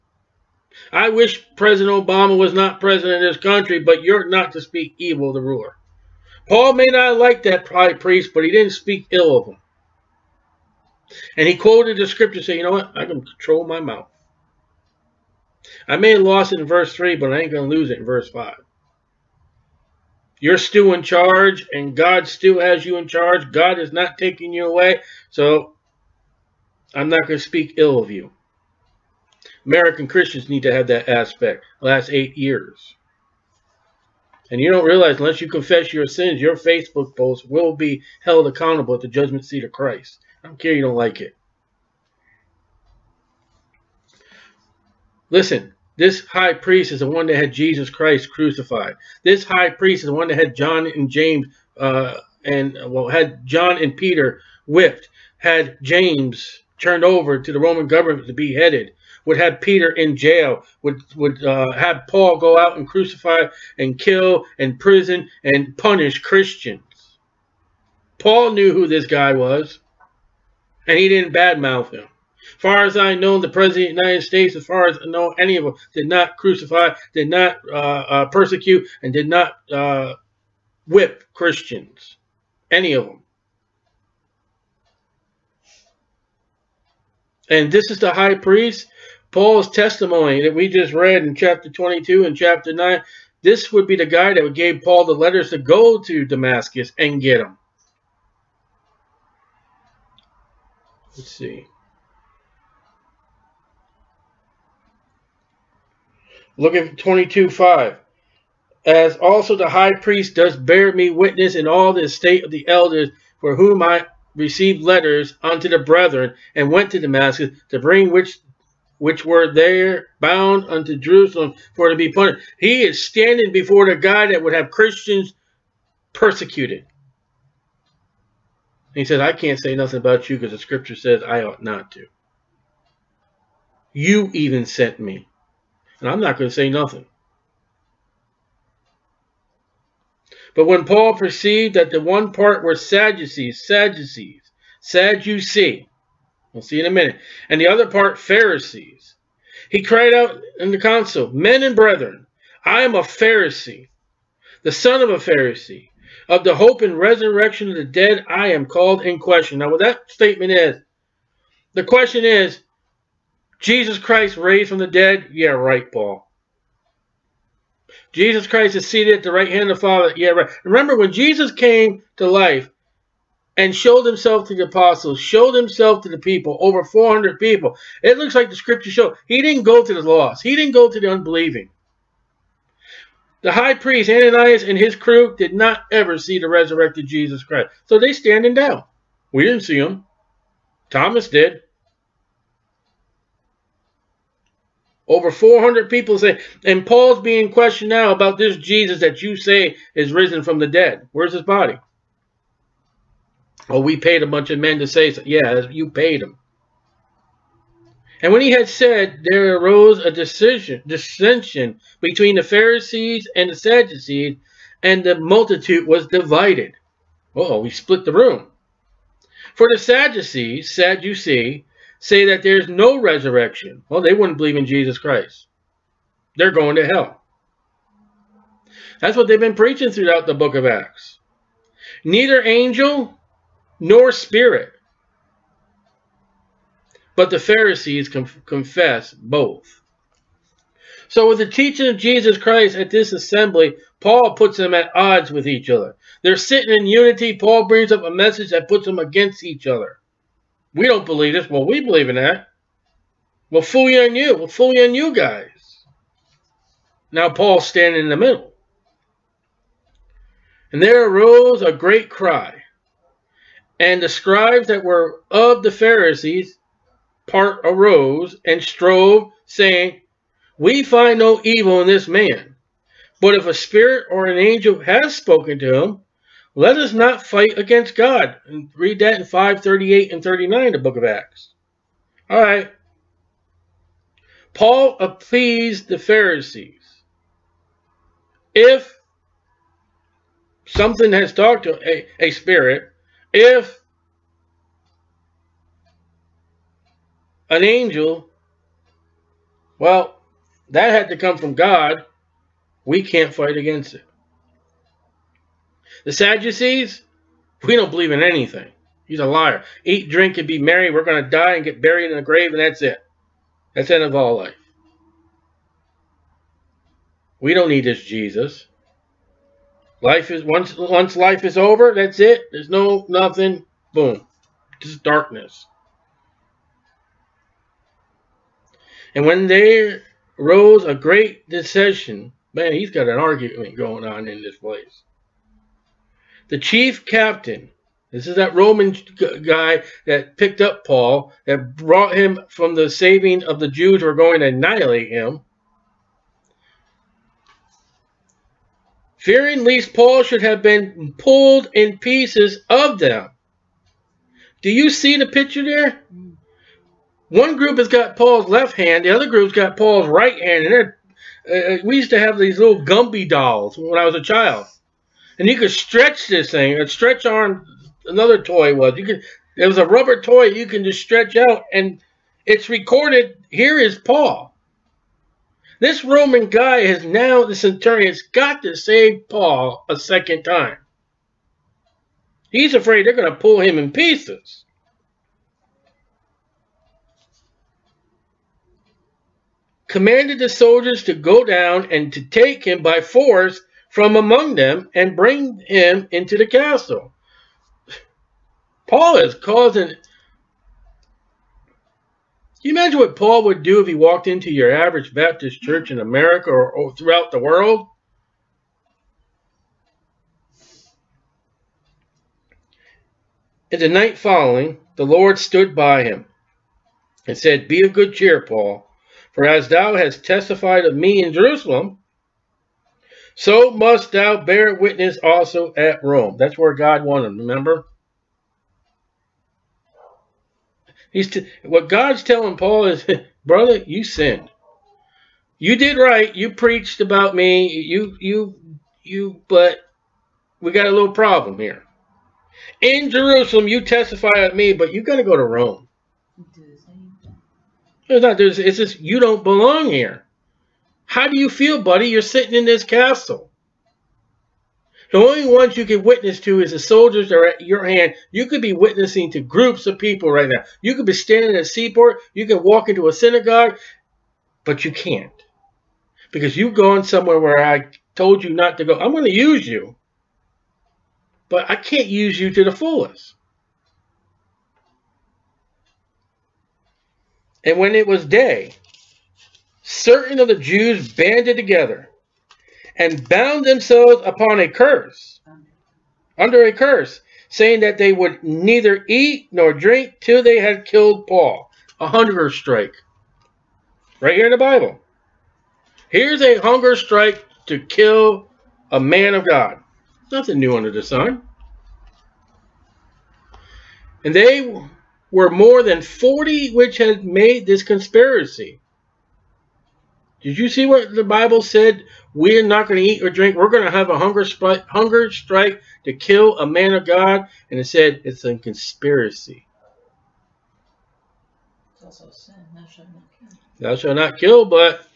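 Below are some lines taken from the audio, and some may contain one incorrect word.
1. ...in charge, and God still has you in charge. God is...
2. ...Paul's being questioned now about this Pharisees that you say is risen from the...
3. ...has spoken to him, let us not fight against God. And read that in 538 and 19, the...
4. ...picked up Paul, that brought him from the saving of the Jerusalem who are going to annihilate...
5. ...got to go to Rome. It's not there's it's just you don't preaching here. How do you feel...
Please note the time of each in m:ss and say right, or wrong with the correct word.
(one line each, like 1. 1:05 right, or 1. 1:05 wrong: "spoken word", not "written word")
1. 0:20 right
2. 3:16 wrong: "Jesus", not "Pharisees"
3. 4:34 wrong: "39", not "19"
4. 5:40 wrong: "Jews", not "Jerusalem"
5. 7:25 wrong: "belong", not "preaching".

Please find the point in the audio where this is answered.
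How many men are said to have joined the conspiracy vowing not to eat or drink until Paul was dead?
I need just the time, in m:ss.
8:25.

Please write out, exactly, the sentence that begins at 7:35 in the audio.
The only ones you can witness to is the soldiers that are at your hand.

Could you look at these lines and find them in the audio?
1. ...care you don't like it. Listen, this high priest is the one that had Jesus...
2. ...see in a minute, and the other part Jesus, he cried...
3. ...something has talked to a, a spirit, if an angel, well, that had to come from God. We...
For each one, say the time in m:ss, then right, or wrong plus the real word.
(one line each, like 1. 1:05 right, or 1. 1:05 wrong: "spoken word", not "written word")
1. 0:40 right
2. 2:26 wrong: "Pharisees", not "Jesus"
3. 4:50 right.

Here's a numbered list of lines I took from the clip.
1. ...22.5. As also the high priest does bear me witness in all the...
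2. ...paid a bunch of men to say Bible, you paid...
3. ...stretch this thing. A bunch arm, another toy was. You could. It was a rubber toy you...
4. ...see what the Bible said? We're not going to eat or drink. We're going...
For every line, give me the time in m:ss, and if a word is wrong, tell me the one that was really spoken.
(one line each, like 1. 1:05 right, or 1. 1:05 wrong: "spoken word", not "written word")
1. 1:46 right
2. 3:23 wrong: "Yeah", not "Bible"
3. 6:05 wrong: "stretch", not "bunch"
4. 8:30 right.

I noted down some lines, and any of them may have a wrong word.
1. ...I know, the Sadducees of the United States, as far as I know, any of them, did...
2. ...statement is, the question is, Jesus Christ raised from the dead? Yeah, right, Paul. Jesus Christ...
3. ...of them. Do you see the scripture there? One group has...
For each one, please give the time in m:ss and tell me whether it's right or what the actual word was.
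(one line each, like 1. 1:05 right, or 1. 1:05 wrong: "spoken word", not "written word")
1. 1:12 wrong: "President", not "Sadducees"
2. 2:40 right
3. 5:52 wrong: "picture", not "scripture".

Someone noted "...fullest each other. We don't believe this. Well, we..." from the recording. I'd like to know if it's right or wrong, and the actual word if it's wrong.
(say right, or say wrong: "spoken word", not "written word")
wrong: "against", not "fullest".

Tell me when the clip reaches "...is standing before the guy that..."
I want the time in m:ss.
2:02.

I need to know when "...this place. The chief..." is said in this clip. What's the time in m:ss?
5:34.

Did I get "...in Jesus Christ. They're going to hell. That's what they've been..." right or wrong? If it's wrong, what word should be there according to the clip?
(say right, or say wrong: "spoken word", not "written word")
right.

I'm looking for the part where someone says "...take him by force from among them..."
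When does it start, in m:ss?
6:32.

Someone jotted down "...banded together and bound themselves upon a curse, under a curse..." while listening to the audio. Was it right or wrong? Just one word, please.
right.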